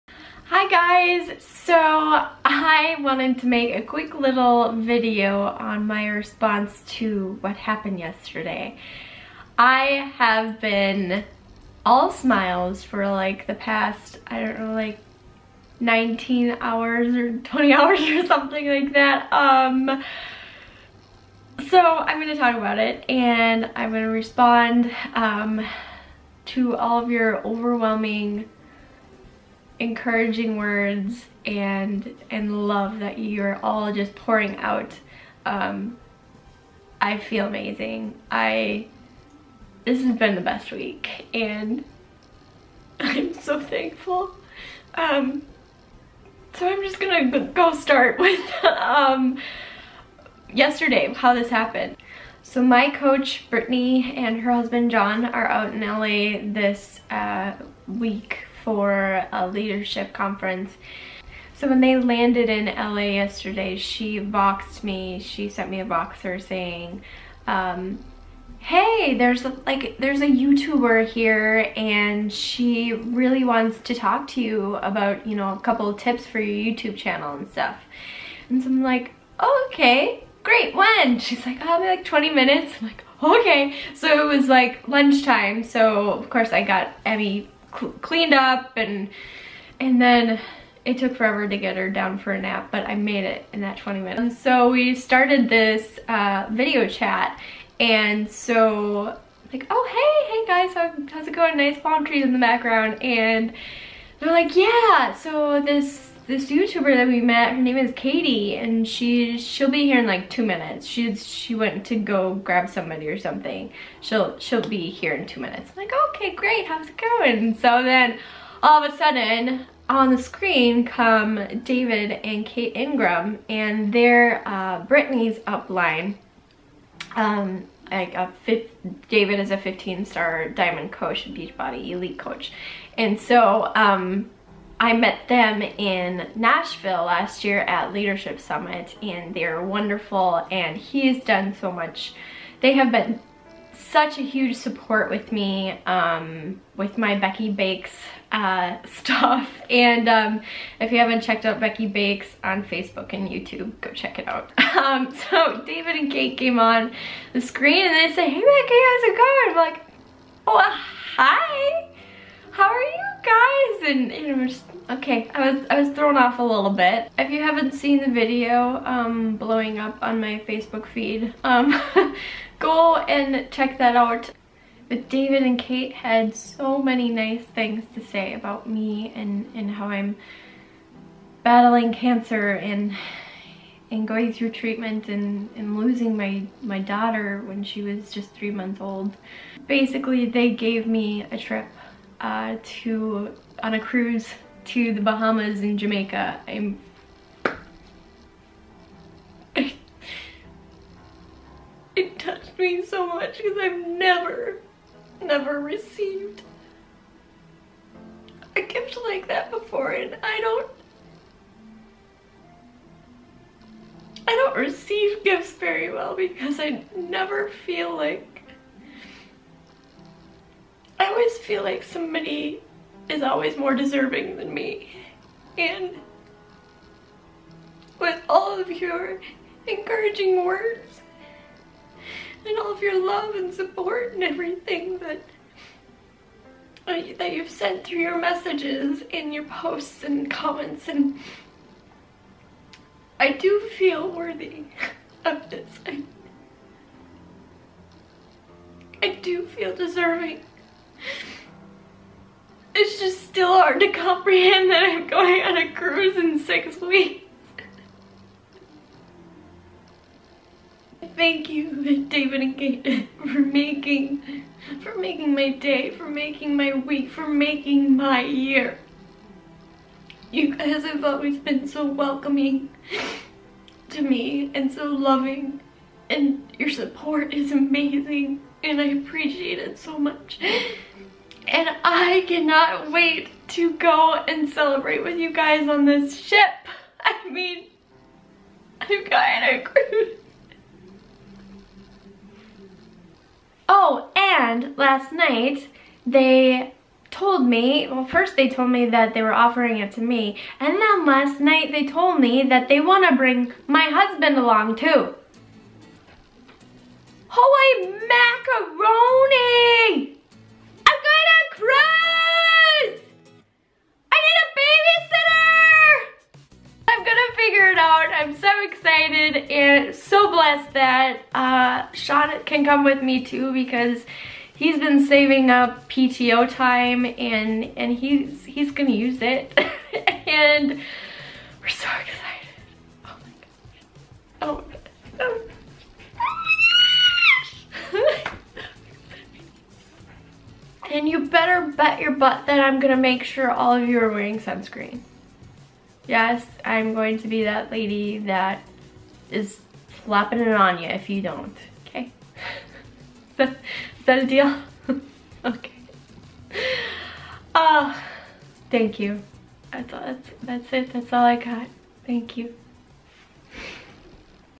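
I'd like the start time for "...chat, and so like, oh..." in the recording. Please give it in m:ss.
1:36.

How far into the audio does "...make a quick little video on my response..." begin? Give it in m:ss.
0:03.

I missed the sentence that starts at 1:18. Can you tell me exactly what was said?
And so I'm like, oh, okay, great, when?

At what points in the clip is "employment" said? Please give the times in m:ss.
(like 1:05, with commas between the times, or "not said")
not said.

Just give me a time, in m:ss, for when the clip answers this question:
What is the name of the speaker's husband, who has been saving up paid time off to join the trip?
5:21.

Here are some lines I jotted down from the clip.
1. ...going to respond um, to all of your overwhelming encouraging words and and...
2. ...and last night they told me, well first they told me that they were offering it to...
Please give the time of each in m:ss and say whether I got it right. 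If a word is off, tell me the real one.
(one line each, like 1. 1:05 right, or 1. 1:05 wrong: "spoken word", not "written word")
1. 0:23 right
2. 4:54 right.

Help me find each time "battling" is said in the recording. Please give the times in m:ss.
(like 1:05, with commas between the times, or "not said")
3:01.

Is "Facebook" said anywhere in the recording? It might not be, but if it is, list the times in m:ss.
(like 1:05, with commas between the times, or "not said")
2:32, 2:50.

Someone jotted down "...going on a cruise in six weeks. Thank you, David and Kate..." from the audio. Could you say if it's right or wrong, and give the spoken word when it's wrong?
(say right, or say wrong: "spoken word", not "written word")
right.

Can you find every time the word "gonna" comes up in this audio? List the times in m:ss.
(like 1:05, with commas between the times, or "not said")
0:46, 5:28, 5:42.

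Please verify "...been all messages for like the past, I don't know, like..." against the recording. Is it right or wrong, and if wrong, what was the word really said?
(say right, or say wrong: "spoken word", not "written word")
wrong: "smiles", not "messages".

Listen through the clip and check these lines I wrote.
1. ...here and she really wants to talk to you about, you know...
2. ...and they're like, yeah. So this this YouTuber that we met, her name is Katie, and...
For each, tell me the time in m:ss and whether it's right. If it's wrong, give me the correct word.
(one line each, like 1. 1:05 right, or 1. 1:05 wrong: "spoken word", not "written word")
1. 1:11 right
2. 1:43 right.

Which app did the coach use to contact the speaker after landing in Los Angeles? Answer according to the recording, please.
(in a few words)
Voxer.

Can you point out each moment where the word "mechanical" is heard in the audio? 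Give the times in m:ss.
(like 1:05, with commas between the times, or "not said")
not said.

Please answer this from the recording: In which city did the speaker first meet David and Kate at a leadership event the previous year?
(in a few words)
Nashville.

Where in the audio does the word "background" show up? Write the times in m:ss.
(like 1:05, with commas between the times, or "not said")
1:42.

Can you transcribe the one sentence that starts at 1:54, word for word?
She'll she'll be here in two minutes.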